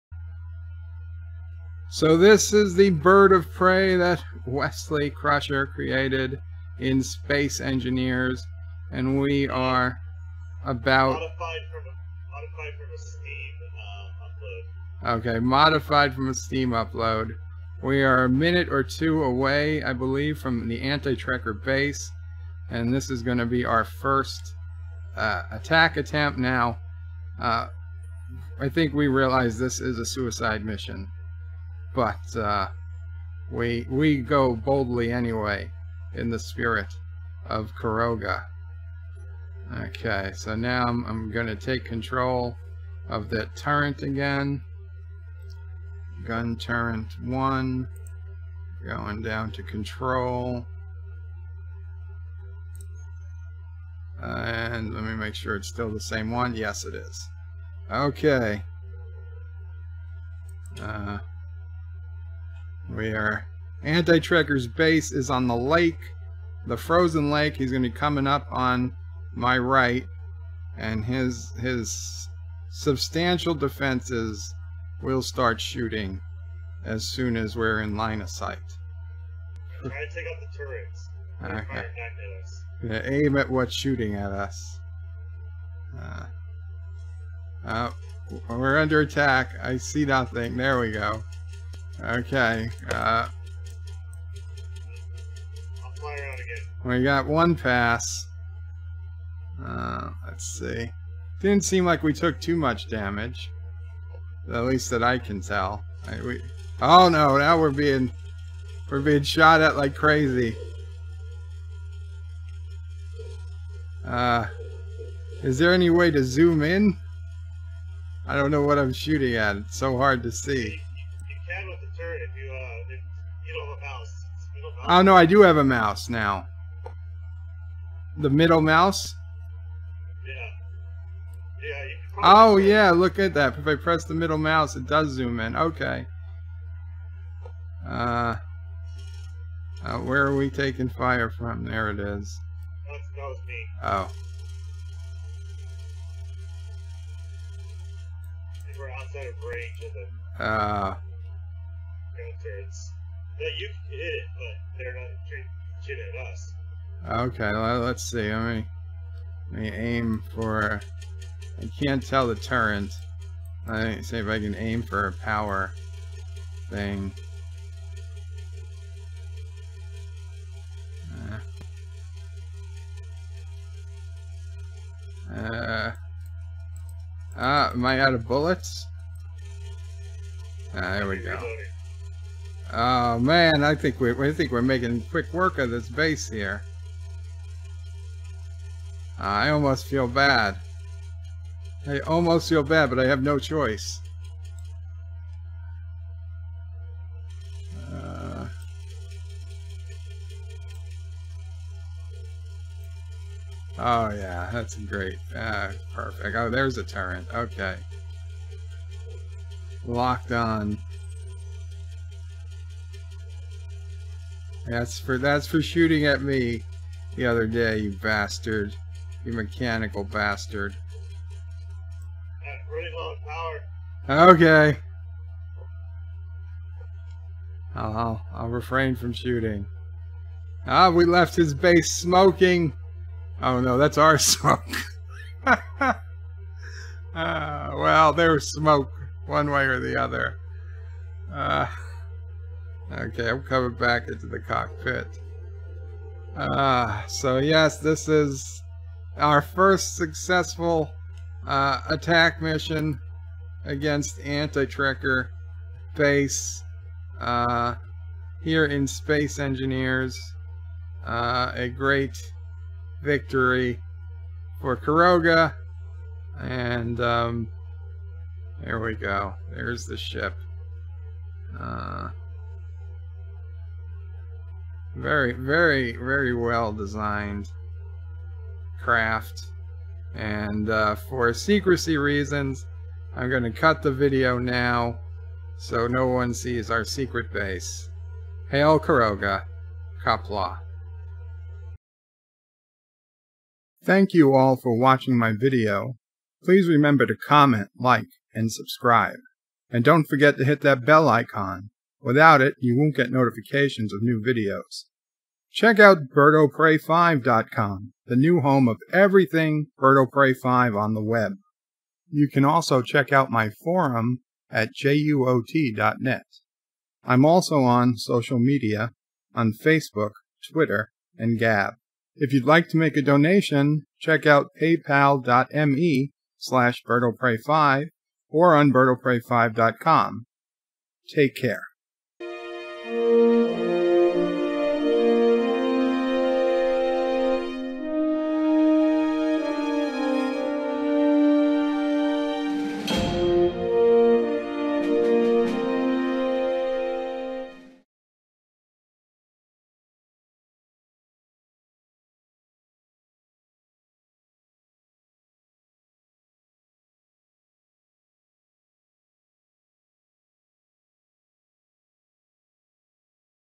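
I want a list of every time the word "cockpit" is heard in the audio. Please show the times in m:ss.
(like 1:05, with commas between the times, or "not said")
4:04.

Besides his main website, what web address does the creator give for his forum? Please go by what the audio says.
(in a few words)
JUOT.net.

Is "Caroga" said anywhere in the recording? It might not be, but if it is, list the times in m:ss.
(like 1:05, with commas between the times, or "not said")
0:37, 4:24, 4:48.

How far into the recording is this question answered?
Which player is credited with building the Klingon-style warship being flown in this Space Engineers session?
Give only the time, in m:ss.
0:04.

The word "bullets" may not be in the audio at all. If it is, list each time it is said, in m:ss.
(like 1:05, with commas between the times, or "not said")
2:58.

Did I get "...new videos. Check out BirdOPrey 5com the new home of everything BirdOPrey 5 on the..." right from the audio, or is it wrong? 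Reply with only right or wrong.
right.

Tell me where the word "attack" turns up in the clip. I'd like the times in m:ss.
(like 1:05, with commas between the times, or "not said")
0:25, 1:29, 4:11.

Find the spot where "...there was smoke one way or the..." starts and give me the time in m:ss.
3:58.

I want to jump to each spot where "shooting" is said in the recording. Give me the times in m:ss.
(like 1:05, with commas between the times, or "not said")
1:15, 1:23, 1:58, 3:35, 3:49.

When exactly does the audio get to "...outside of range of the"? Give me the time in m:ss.
2:28.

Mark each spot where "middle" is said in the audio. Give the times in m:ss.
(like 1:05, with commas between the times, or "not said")
2:08, 2:14.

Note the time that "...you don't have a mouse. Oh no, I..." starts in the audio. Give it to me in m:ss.
2:03.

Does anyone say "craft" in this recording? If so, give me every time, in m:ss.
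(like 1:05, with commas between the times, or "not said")
4:38.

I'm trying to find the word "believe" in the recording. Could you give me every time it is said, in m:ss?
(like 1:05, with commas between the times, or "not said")
0:19.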